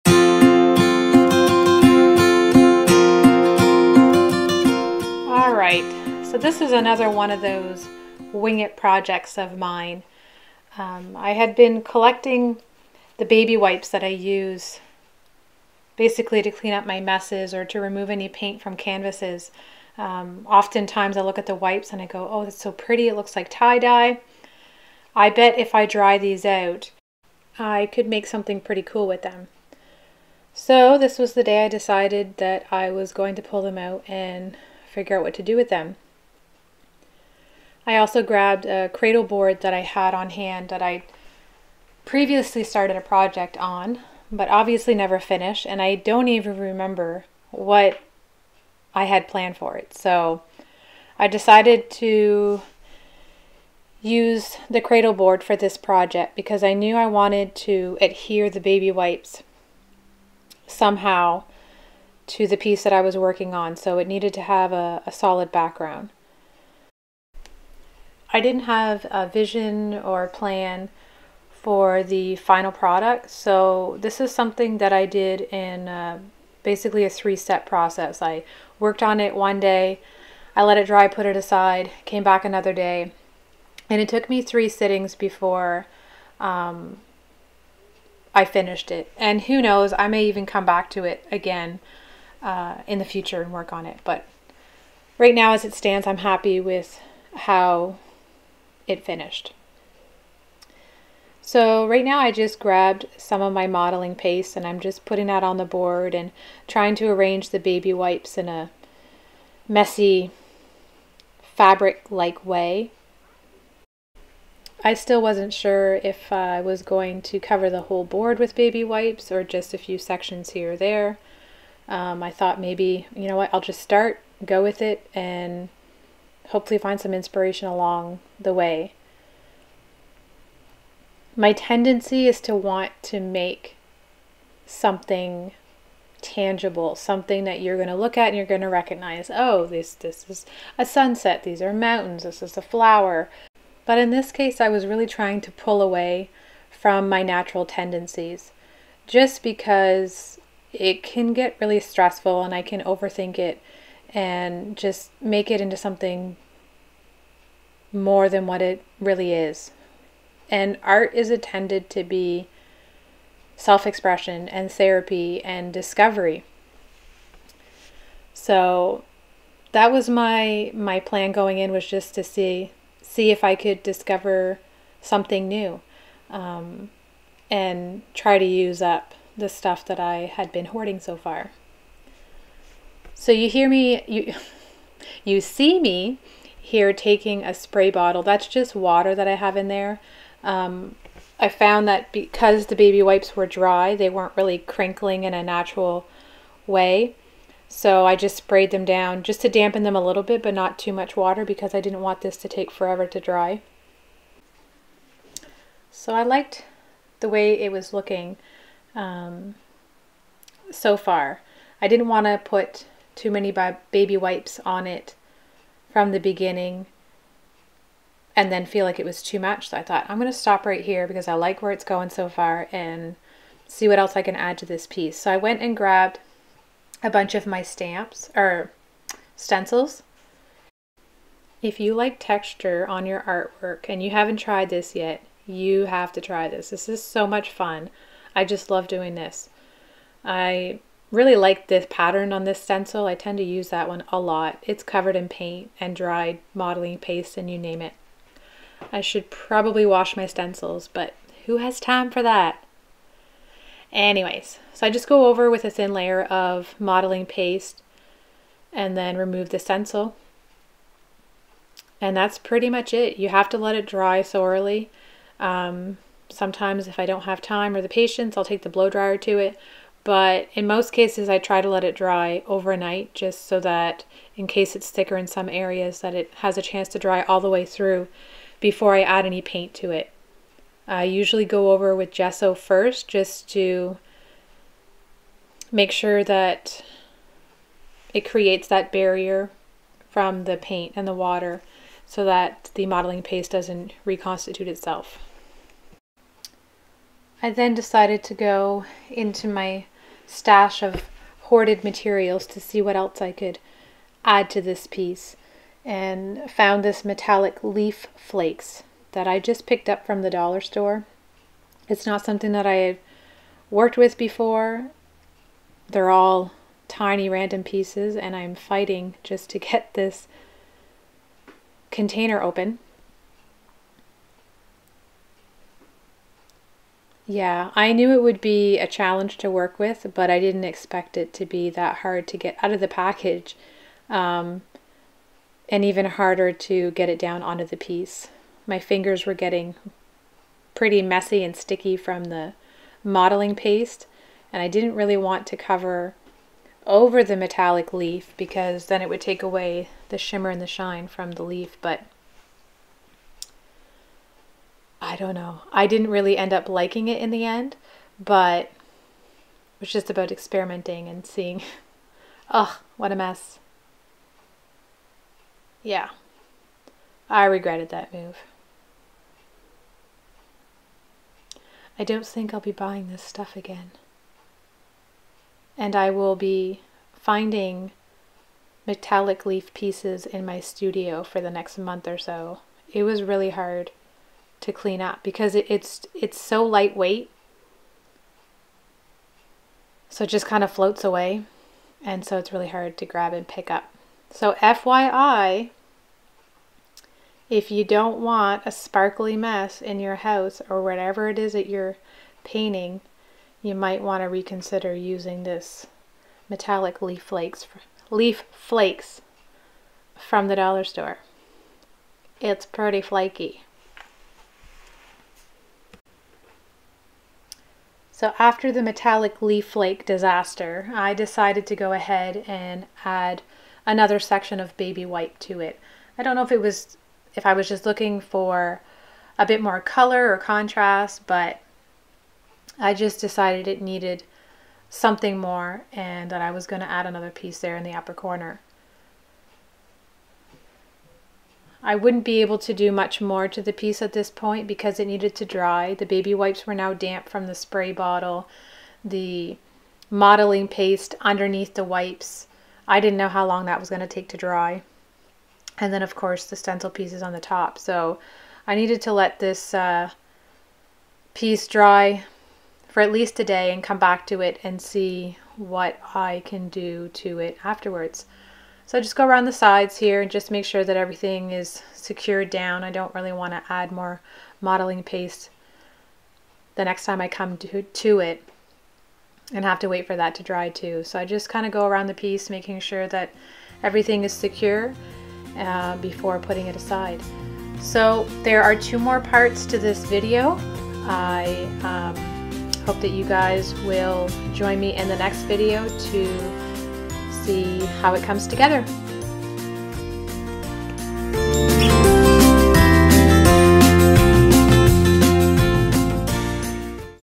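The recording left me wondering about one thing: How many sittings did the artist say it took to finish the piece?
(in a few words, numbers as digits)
3.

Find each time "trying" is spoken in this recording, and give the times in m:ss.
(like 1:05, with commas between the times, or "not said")
1:46, 2:25.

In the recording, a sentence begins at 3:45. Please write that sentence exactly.
So I went and grabbed a bunch of my stamps or stencils.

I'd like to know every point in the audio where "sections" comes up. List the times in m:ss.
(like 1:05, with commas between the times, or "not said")
1:59, 7:04.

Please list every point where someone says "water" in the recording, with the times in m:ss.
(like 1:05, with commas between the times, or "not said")
3:08, 3:21, 4:51.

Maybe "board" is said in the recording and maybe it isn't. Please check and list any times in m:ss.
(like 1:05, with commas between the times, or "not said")
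0:39, 0:55, 1:45, 1:58.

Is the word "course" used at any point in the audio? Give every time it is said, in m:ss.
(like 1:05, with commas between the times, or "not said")
7:36.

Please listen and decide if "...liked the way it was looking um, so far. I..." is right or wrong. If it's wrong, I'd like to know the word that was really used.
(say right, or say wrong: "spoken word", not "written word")
right.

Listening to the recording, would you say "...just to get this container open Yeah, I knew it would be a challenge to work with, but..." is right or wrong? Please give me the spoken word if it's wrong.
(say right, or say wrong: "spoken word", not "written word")
right.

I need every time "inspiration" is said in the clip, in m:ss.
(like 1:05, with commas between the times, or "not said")
2:07.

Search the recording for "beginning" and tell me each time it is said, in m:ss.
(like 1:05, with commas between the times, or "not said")
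3:36.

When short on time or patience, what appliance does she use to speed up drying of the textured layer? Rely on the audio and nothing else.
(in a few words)
blow dryer.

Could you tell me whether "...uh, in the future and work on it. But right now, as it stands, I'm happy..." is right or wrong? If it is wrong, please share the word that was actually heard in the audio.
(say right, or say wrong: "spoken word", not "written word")
right.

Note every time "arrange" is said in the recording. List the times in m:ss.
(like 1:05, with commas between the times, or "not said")
1:47.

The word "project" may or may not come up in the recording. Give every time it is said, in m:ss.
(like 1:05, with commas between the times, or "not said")
0:08, 0:43, 0:55.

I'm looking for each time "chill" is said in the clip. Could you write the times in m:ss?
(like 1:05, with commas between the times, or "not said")
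not said.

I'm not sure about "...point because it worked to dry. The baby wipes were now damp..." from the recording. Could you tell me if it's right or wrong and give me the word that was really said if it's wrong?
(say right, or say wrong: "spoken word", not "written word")
wrong: "needed", not "worked".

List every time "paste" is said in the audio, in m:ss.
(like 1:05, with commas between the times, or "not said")
1:44, 4:06, 4:17, 4:53, 5:43, 7:30, 7:55.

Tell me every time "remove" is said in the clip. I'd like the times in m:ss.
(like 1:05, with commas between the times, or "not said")
0:17, 4:19.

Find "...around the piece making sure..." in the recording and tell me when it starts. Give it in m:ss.
8:01.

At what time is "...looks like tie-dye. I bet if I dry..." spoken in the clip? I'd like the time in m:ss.
0:23.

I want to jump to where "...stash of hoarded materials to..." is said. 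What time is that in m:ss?
5:00.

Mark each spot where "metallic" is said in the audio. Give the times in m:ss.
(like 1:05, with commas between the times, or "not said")
5:07, 5:47, 6:18, 6:46, 6:58.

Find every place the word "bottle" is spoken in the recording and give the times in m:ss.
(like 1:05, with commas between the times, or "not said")
3:07, 7:27.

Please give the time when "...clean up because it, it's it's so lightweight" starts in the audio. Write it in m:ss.
6:24.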